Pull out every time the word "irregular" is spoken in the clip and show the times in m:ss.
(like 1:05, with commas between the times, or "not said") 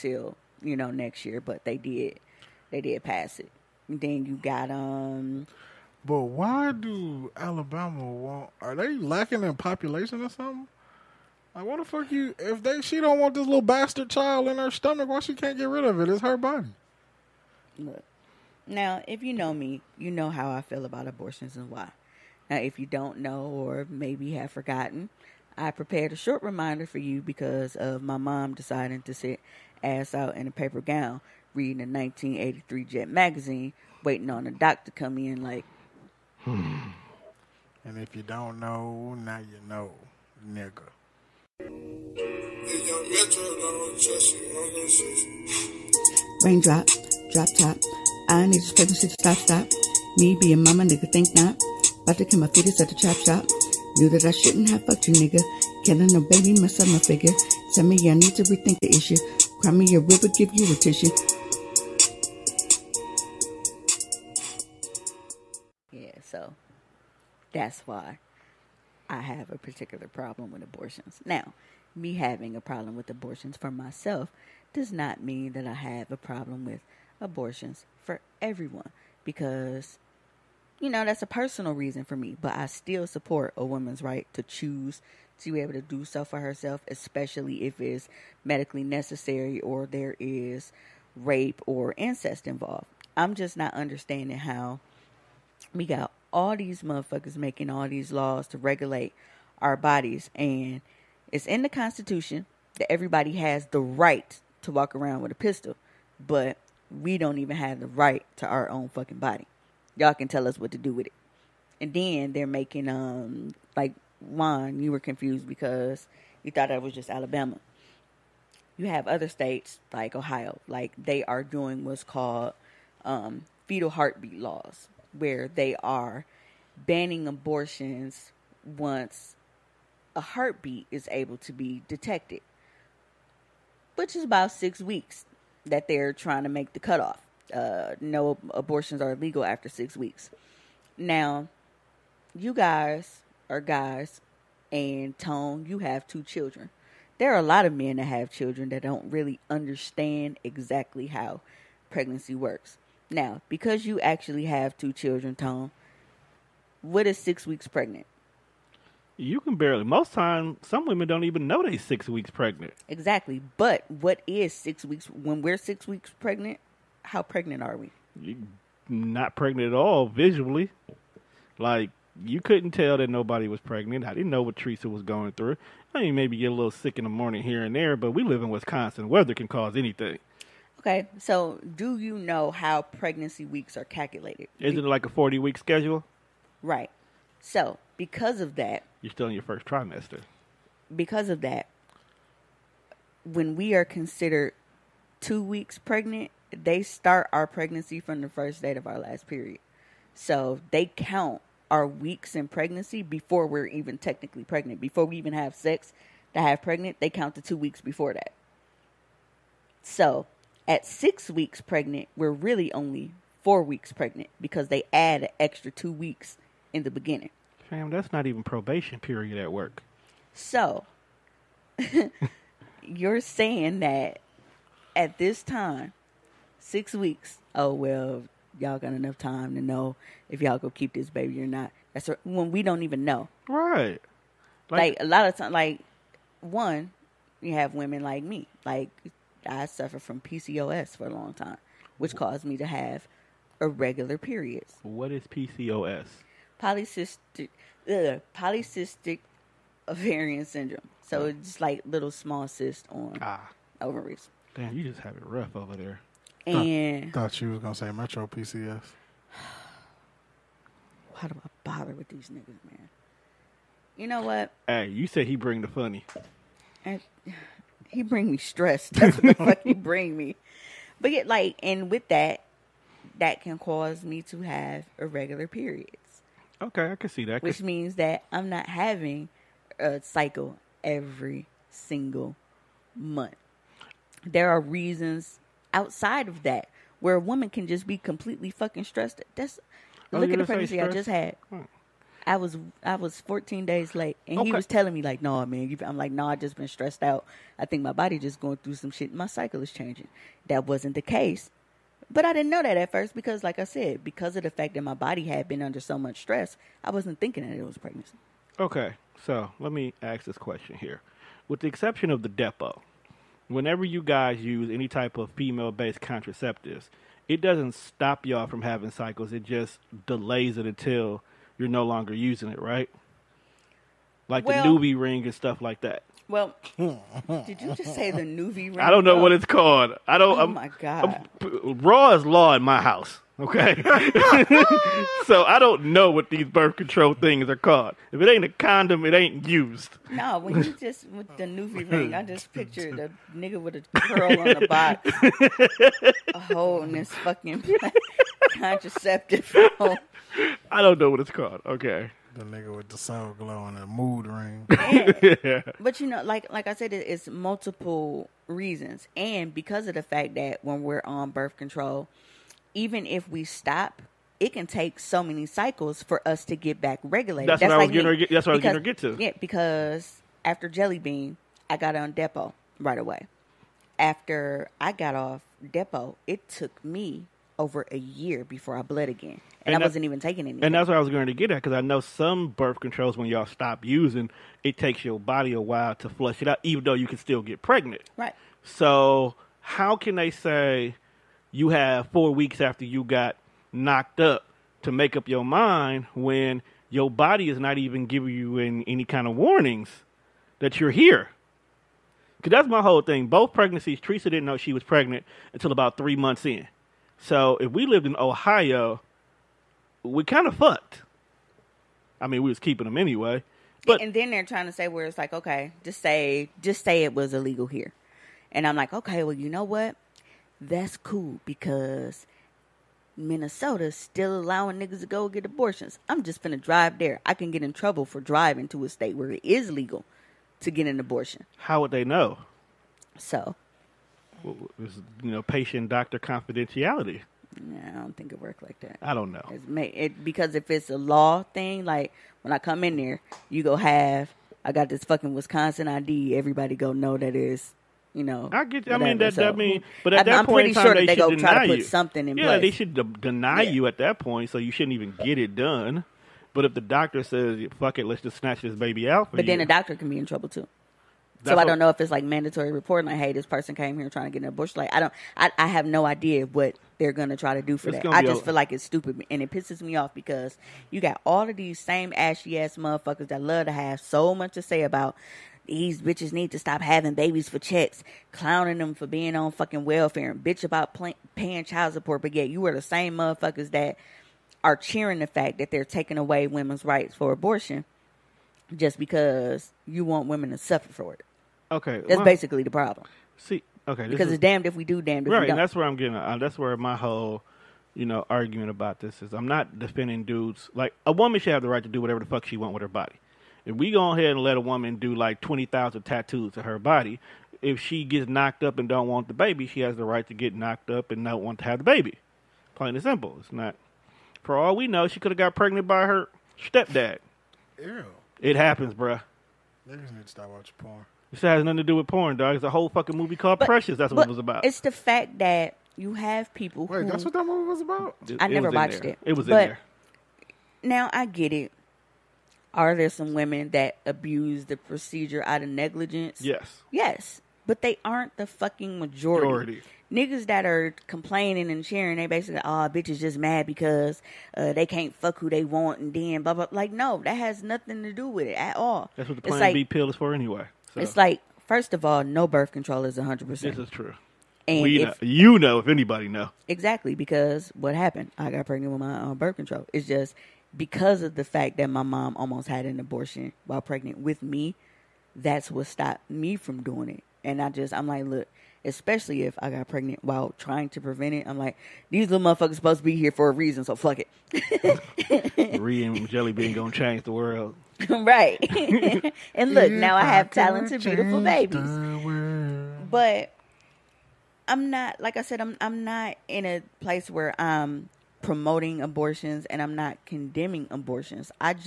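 4:03, 4:34.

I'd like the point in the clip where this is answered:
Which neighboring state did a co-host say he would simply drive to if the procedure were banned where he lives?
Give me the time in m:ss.
7:03.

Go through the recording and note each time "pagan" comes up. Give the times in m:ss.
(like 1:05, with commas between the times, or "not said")
not said.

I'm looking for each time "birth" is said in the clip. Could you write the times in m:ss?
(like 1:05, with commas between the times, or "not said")
5:36, 6:01, 6:22, 9:12, 9:19.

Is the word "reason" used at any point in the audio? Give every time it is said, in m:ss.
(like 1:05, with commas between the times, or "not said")
1:21, 4:44, 5:58, 9:33.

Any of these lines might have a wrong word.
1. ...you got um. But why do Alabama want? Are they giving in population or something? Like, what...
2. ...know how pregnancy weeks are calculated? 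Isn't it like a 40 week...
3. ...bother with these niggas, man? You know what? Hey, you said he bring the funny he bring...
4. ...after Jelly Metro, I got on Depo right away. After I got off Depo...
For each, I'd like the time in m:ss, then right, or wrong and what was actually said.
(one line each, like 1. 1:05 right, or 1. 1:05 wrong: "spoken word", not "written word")
1. 0:04 wrong: "lacking", not "giving"
2. 3:02 right
3. 4:21 right
4. 6:10 wrong: "Bean", not "Metro".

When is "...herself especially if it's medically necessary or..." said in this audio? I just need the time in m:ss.
1:26.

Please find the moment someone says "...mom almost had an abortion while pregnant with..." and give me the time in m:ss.
9:22.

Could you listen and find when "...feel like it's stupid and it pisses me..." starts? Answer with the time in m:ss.
7:48.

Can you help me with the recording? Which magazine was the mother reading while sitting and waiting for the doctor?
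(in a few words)
Jet.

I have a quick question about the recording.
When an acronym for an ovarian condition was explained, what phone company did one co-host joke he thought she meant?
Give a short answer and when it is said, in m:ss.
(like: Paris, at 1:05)
Metro PCS, at 4:17.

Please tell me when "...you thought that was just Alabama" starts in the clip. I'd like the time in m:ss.
1:56.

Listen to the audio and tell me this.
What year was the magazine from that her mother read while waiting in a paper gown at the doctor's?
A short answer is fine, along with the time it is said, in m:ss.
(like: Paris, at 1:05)
1983, at 0:31.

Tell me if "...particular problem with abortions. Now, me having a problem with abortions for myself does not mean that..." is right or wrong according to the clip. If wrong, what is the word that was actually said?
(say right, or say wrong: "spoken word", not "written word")
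right.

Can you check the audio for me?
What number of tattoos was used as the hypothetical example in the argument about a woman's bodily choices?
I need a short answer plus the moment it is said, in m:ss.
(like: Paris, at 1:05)
20000, at 8:25.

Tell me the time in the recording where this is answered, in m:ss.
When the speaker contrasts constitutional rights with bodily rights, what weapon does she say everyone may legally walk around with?
1:45.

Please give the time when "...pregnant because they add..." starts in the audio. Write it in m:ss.
3:33.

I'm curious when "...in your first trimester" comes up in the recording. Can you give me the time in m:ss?
3:09.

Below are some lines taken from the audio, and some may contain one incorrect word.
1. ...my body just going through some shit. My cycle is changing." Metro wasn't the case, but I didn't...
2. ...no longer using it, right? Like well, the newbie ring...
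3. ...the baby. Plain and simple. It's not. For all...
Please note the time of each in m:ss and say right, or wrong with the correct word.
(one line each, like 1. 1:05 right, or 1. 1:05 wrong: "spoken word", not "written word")
1. 4:57 wrong: "That", not "Metro"
2. 5:21 right
3. 8:31 right.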